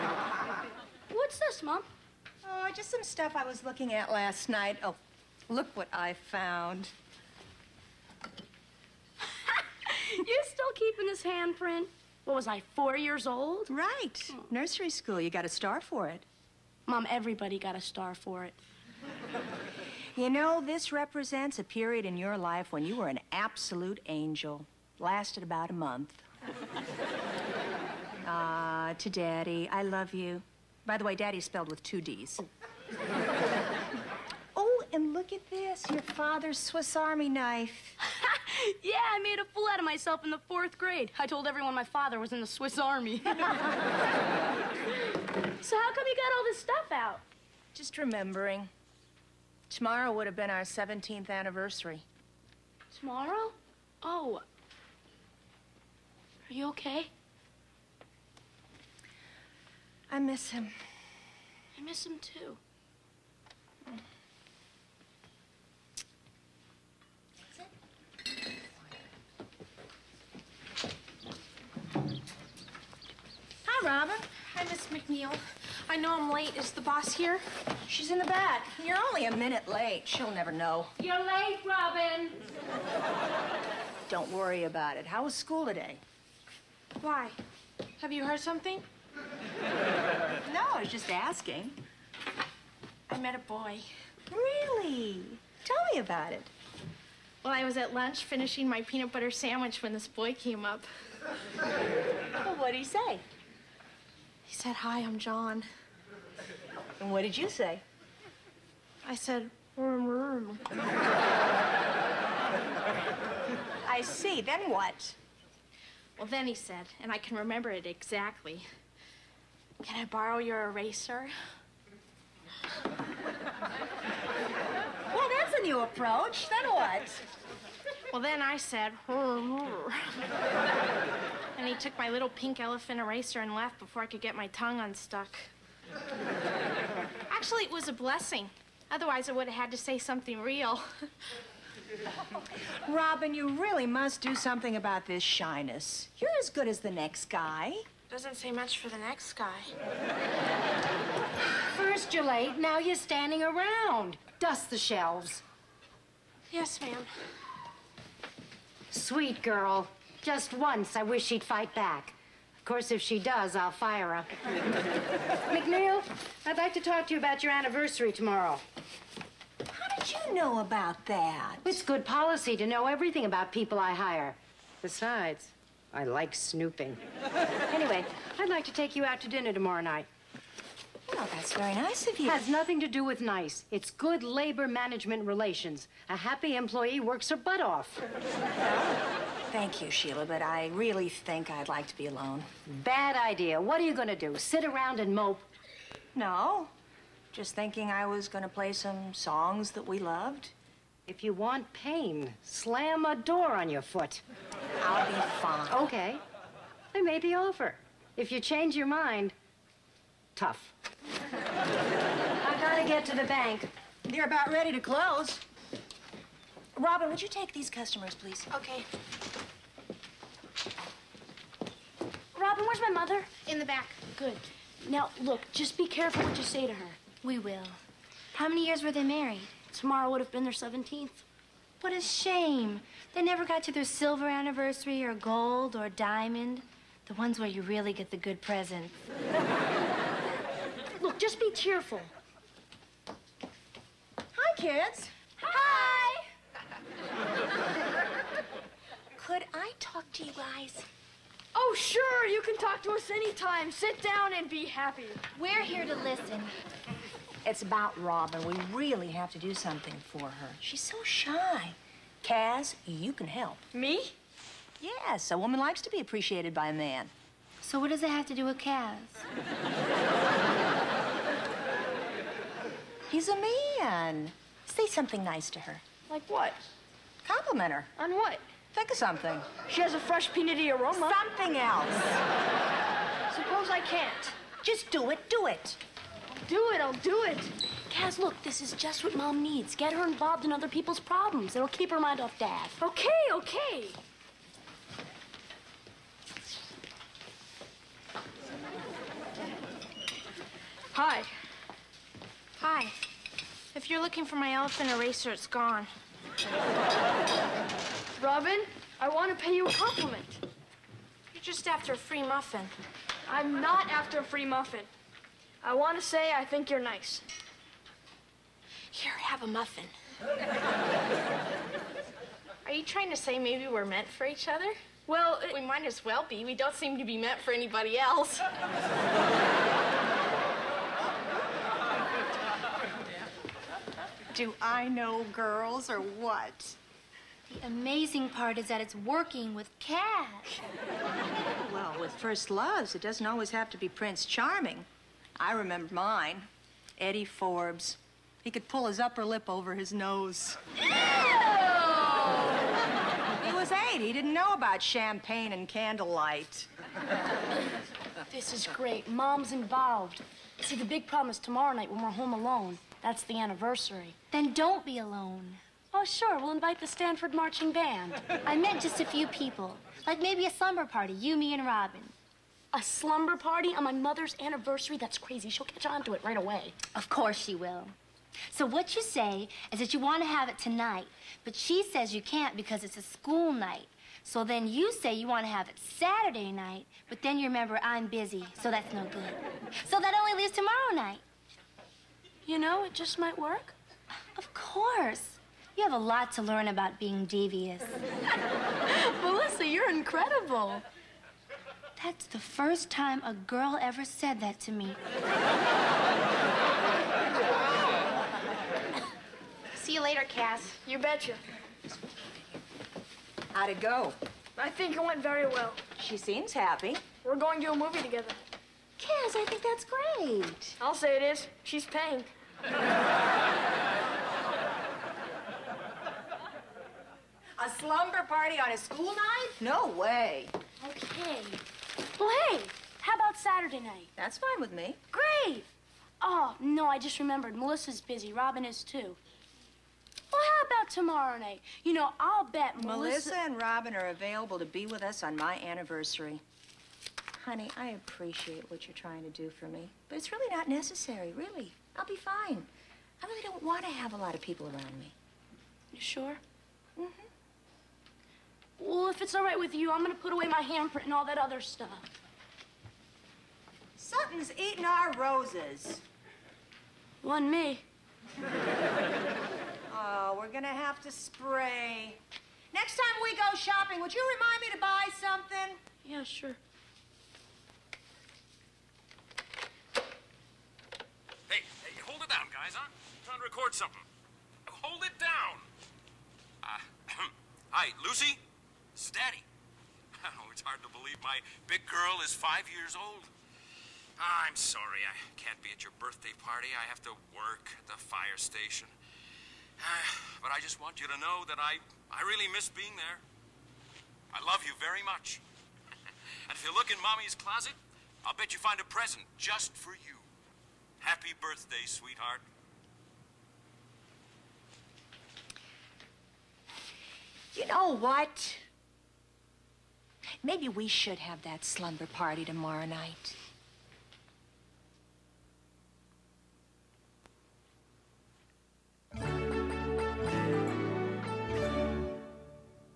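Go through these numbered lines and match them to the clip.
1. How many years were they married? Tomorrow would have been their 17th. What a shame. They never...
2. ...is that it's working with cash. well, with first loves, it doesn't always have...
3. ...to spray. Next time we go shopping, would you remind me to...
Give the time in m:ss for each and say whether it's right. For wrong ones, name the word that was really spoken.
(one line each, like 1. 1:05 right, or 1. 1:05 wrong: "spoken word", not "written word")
1. 3:48 right
2. 5:38 right
3. 7:51 right.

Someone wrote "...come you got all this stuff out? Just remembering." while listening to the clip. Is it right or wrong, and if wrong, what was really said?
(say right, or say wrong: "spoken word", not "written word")
right.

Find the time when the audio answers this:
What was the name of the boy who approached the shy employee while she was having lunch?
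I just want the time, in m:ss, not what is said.
1:45.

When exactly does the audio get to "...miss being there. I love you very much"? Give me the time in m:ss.
8:22.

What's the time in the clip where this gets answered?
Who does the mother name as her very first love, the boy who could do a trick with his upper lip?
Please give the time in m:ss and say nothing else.
5:46.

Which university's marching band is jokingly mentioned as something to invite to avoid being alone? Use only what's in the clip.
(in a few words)
Stanford.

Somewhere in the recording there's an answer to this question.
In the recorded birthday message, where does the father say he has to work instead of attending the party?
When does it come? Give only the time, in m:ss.
8:18.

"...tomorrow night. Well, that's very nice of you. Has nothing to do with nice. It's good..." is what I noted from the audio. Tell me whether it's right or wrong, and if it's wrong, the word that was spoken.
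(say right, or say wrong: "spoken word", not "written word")
right.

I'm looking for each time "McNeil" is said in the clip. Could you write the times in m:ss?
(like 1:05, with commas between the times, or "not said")
1:14, 2:45.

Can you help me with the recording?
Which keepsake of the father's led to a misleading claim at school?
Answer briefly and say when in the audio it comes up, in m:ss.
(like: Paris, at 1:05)
Swiss Army knife, at 0:36.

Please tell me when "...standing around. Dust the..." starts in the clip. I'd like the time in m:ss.
2:32.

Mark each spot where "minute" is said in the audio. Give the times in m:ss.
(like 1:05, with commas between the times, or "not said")
1:19.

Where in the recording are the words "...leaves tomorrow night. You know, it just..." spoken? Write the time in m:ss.
6:30.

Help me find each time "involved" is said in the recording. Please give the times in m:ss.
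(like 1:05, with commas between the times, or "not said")
4:50, 5:59.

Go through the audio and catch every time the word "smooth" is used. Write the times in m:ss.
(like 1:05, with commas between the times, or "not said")
not said.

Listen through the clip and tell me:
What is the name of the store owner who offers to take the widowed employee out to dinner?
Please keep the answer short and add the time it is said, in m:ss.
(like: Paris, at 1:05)
Sheila, at 3:09.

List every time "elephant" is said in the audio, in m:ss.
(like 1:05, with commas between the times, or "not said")
2:12, 5:04.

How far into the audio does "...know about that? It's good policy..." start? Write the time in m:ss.
2:50.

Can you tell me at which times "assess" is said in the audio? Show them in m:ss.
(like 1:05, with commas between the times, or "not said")
not said.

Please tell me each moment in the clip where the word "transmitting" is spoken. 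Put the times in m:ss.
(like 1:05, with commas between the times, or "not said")
not said.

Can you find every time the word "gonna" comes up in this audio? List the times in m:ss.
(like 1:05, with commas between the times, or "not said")
7:40, 7:50.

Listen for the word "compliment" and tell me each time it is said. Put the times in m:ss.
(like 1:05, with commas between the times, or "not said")
4:37, 5:09.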